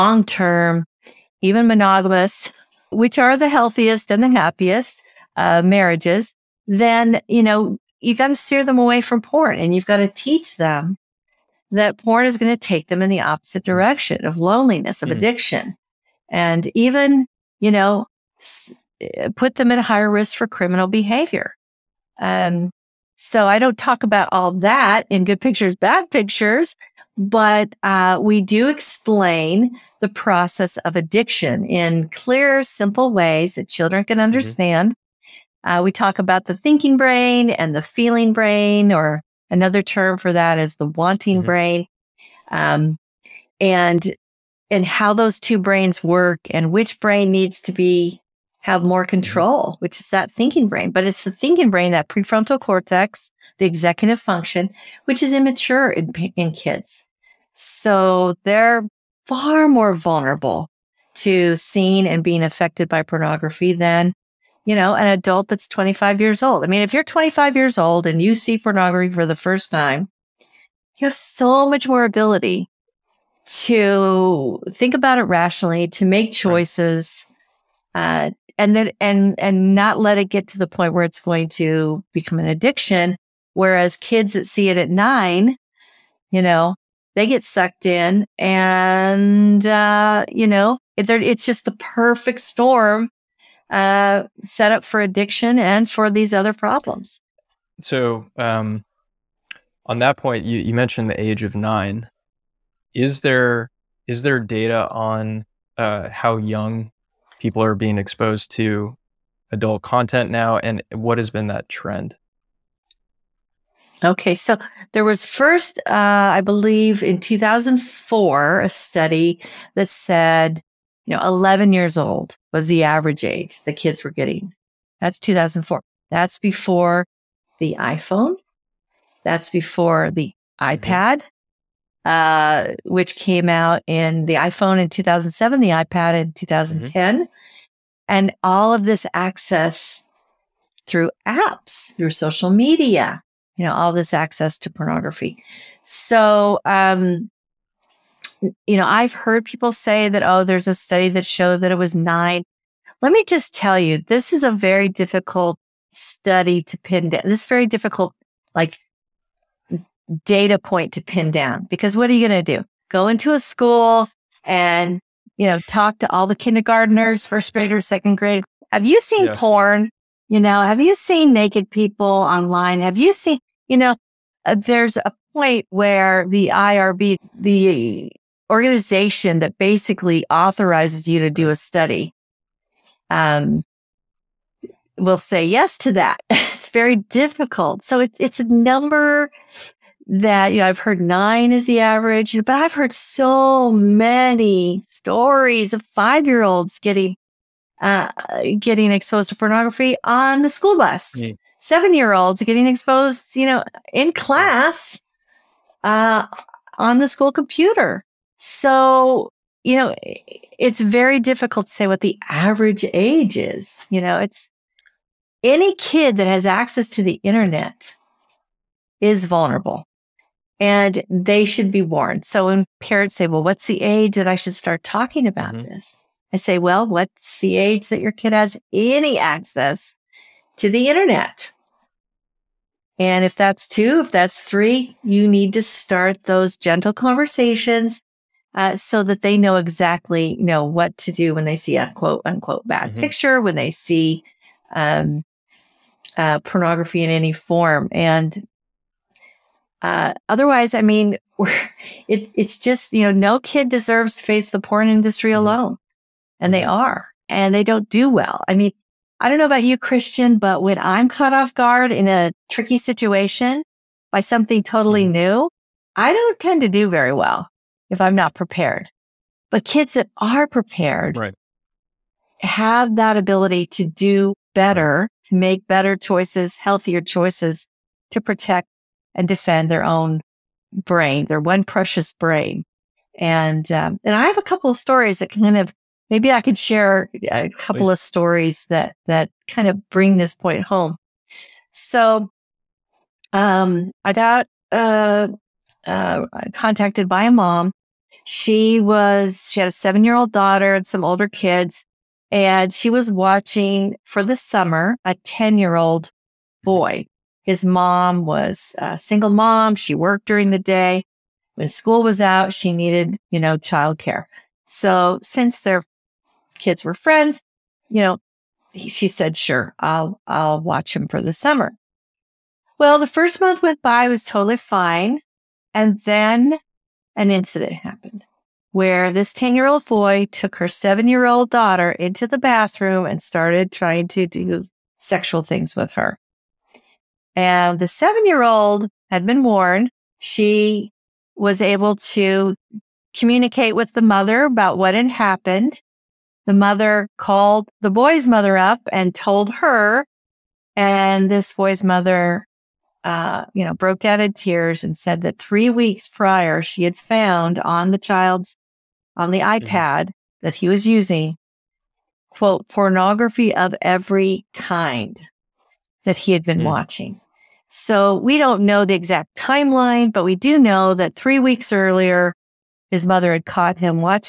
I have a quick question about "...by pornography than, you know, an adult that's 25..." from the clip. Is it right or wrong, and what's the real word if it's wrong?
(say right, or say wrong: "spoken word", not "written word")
right.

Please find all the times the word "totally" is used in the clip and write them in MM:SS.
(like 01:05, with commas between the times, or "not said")
04:24, 05:24.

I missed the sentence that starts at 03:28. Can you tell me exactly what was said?
So, you know, it's very difficult to say what the average age is.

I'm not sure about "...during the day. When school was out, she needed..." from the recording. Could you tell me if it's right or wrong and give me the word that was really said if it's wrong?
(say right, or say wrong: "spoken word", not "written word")
right.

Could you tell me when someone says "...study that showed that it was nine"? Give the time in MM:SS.
02:30.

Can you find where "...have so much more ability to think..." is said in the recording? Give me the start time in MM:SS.
01:11.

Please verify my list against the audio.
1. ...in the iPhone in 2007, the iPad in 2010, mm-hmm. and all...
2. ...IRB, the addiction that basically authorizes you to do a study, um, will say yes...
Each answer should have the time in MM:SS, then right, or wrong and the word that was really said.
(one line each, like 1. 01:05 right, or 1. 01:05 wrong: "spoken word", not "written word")
1. 02:13 right
2. 02:56 wrong: "organization", not "addiction".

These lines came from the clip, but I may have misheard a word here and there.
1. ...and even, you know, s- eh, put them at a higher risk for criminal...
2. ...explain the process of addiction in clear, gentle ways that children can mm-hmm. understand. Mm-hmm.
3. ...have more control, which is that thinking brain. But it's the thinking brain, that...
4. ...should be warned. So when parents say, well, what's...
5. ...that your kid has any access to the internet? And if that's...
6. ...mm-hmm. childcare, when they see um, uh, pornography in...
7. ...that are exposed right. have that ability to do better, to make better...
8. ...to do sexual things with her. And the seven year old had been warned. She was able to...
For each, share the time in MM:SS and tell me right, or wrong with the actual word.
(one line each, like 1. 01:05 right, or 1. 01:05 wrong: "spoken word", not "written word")
1. 00:16 right
2. 00:28 wrong: "simple", not "gentle"
3. 00:48 right
4. 03:41 right
5. 03:47 right
6. 04:02 wrong: "picture", not "childcare"
7. 04:29 wrong: "prepared", not "exposed"
8. 05:34 right.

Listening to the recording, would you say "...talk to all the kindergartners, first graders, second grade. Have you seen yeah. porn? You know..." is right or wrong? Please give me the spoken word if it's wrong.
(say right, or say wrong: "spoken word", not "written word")
right.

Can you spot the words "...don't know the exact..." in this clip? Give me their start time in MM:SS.
06:08.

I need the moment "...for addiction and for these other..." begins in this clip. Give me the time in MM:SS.
01:34.